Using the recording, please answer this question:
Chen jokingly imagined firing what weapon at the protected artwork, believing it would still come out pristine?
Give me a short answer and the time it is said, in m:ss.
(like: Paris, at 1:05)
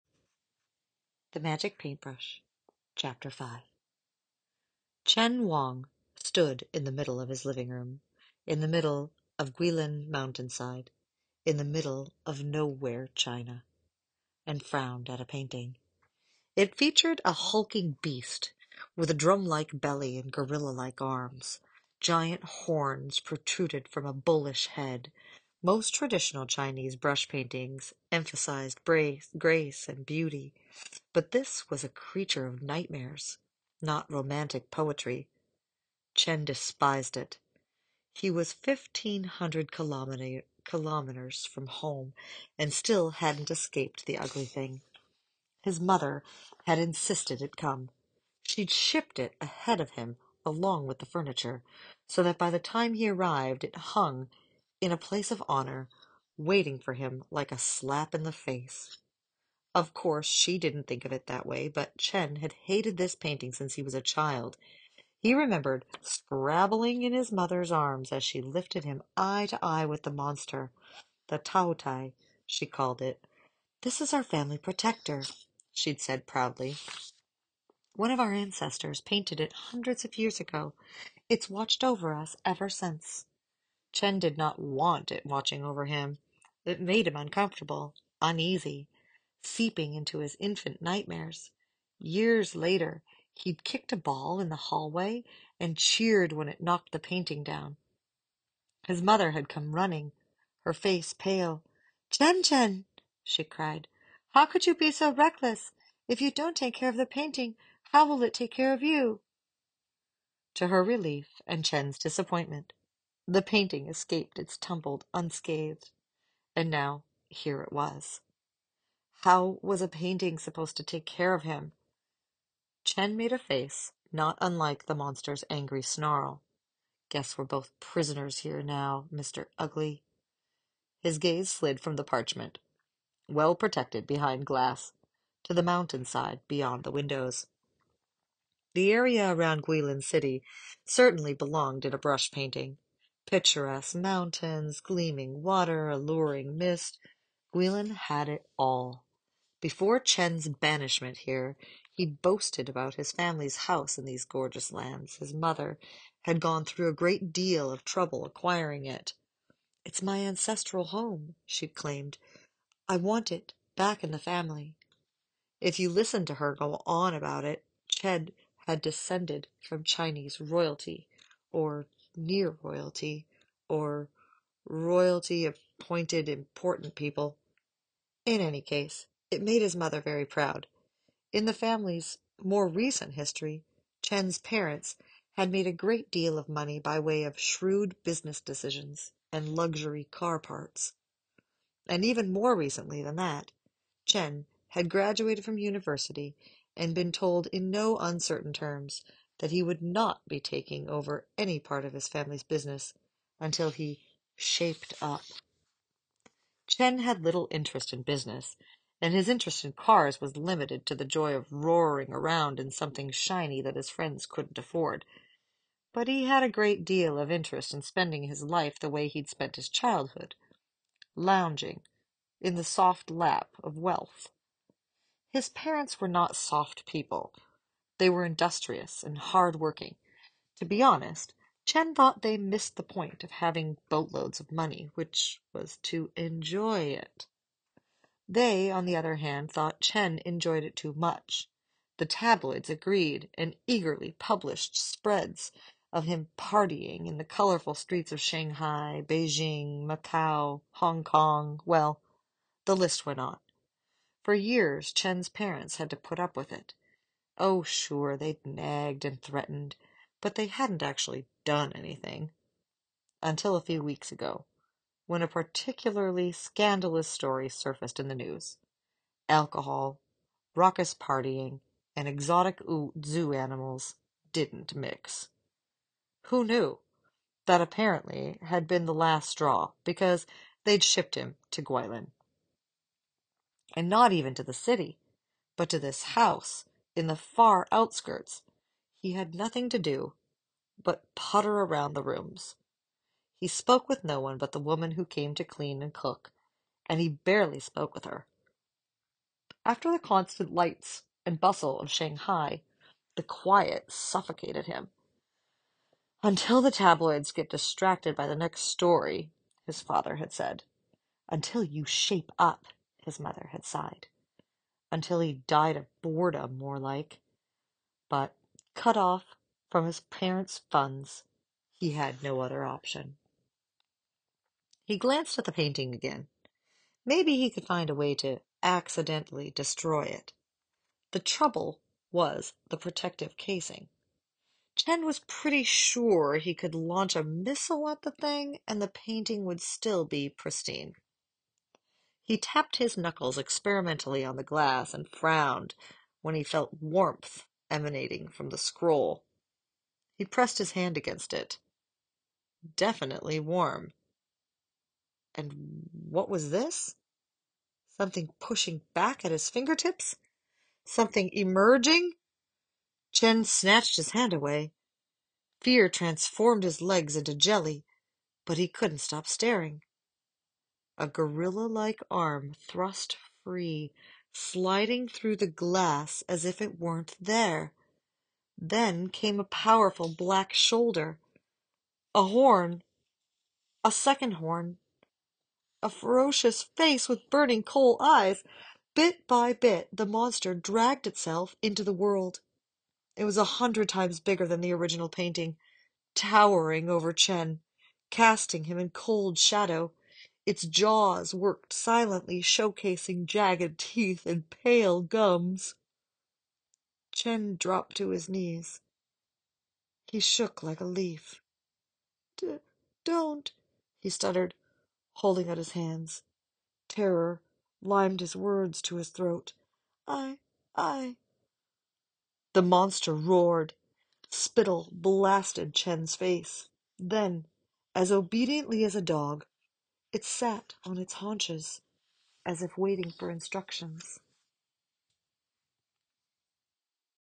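A missile, at 5:37.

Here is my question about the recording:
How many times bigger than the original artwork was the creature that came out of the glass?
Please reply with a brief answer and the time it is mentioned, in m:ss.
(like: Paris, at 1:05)
100, at 6:33.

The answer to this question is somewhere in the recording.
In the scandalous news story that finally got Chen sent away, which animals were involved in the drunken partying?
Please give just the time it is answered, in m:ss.
4:32.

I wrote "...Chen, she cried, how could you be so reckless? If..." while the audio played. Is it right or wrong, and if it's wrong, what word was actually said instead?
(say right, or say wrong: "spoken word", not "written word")
right.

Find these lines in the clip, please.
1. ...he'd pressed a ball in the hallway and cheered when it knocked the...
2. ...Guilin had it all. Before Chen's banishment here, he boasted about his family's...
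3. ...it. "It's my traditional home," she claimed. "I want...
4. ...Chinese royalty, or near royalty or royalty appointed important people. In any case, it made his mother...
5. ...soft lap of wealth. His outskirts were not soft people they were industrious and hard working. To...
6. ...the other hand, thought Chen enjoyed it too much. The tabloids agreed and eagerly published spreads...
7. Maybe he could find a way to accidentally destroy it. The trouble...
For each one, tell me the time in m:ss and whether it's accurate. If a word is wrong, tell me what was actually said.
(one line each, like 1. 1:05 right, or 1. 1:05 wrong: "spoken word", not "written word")
1. 1:33 wrong: "kicked", not "pressed"
2. 2:27 right
3. 2:38 wrong: "ancestral", not "traditional"
4. 2:49 right
5. 3:42 wrong: "parents", not "outskirts"
6. 3:58 right
7. 5:27 right.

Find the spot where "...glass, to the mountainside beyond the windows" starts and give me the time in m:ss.
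2:14.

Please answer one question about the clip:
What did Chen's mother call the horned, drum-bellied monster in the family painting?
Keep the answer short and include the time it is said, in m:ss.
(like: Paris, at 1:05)
Taotie, at 1:11.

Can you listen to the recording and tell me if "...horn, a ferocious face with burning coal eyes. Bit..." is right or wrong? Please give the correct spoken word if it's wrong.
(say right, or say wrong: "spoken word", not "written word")
right.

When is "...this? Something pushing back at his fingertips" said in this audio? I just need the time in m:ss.
5:56.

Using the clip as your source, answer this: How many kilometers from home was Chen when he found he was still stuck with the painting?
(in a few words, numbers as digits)
1,500.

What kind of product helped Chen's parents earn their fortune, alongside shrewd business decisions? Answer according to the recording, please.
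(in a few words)
Luxury car parts.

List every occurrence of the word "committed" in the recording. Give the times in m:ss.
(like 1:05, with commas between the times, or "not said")
not said.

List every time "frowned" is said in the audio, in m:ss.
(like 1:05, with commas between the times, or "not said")
0:14, 5:45.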